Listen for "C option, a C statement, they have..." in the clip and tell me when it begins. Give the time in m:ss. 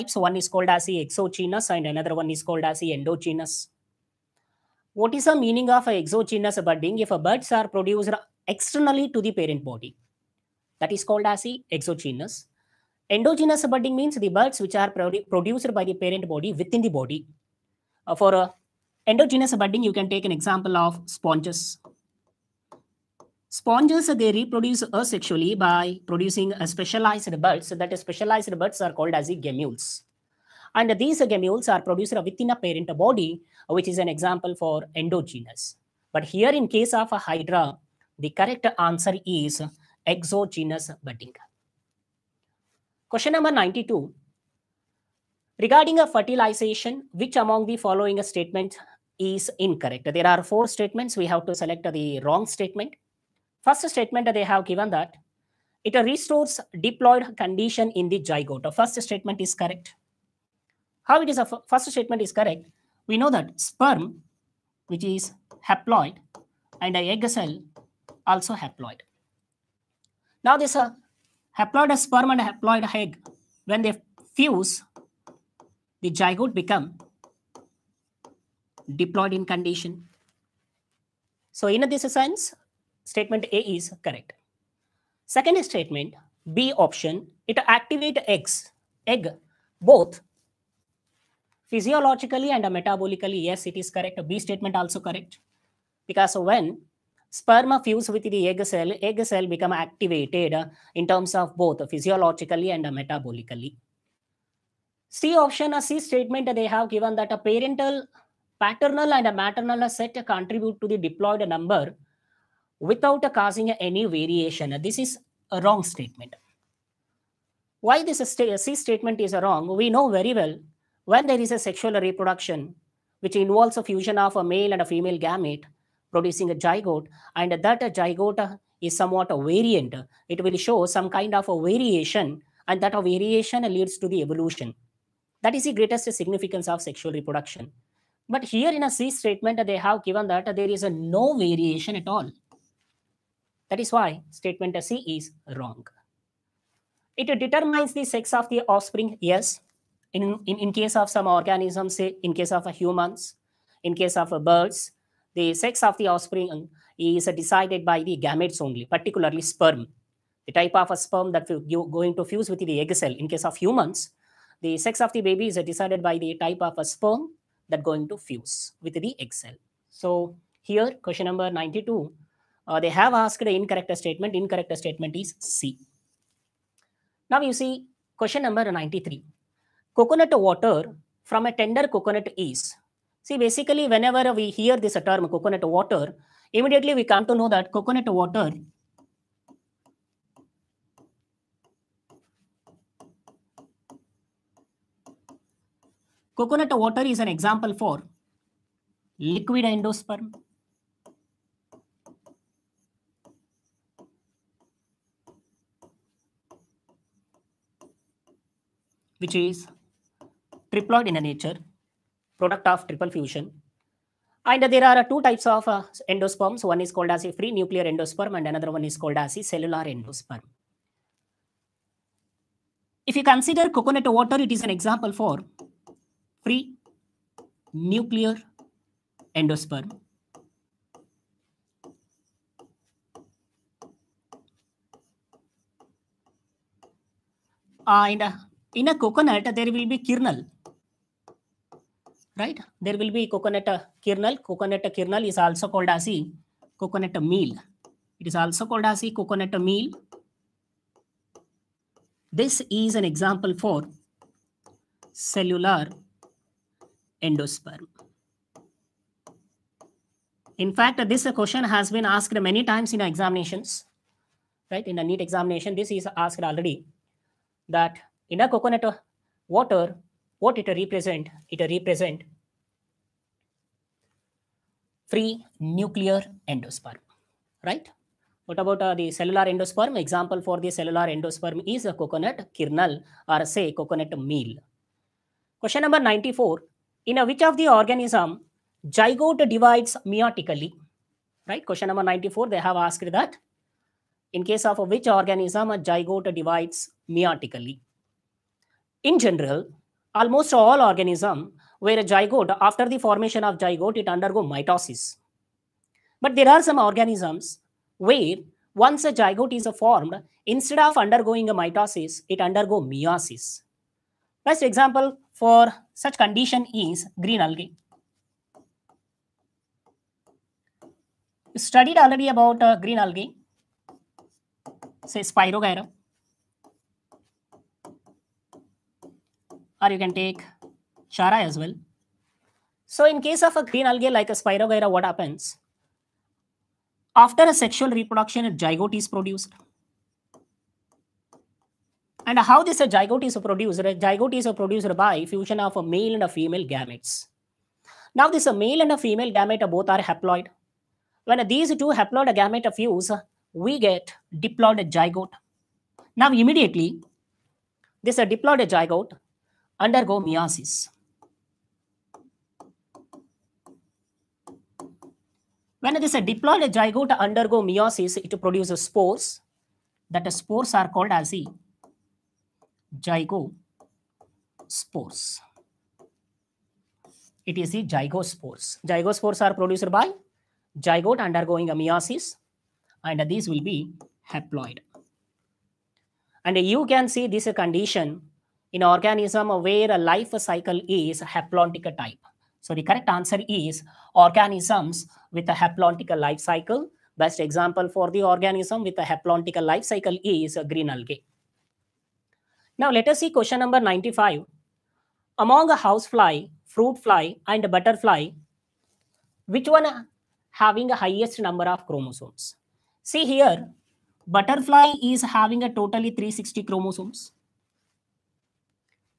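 1:45.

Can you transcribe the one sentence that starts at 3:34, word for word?
And there are two types of uh, endosperms.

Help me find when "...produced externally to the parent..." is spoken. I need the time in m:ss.
0:07.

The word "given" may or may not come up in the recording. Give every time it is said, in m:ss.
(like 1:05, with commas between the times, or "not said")
0:54, 1:46, 2:20.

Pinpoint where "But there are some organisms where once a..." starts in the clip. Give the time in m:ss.
5:06.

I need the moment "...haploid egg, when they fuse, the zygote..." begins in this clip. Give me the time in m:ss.
1:12.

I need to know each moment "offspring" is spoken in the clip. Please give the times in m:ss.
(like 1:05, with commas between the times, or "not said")
2:28, 2:36.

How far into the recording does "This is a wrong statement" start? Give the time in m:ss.
1:54.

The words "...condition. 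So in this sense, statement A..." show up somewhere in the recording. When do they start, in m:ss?
1:19.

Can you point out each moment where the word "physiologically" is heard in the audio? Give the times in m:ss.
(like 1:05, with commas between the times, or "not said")
1:31, 1:41.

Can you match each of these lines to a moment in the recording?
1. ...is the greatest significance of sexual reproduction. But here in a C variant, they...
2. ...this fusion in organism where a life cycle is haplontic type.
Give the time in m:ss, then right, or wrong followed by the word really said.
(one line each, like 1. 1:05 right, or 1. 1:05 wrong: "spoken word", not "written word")
1. 2:15 wrong: "statement", not "variant"
2. 6:27 wrong: "condition", not "fusion".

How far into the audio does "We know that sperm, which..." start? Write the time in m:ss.
1:03.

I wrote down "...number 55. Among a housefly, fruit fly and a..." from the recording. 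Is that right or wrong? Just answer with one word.
wrong.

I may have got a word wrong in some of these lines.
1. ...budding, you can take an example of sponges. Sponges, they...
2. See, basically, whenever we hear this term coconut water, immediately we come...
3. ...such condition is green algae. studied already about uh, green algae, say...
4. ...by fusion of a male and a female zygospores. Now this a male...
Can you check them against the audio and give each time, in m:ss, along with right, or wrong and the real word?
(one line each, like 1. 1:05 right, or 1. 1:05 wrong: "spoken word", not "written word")
1. 0:19 right
2. 3:03 right
3. 5:16 right
4. 5:44 wrong: "gametes", not "zygospores".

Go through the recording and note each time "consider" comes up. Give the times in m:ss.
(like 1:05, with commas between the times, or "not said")
3:43.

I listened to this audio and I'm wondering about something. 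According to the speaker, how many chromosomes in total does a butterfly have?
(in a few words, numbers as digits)
360.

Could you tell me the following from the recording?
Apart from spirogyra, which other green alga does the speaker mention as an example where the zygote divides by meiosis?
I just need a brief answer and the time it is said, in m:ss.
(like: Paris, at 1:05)
Chara, at 5:31.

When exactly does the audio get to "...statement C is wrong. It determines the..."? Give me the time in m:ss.
2:24.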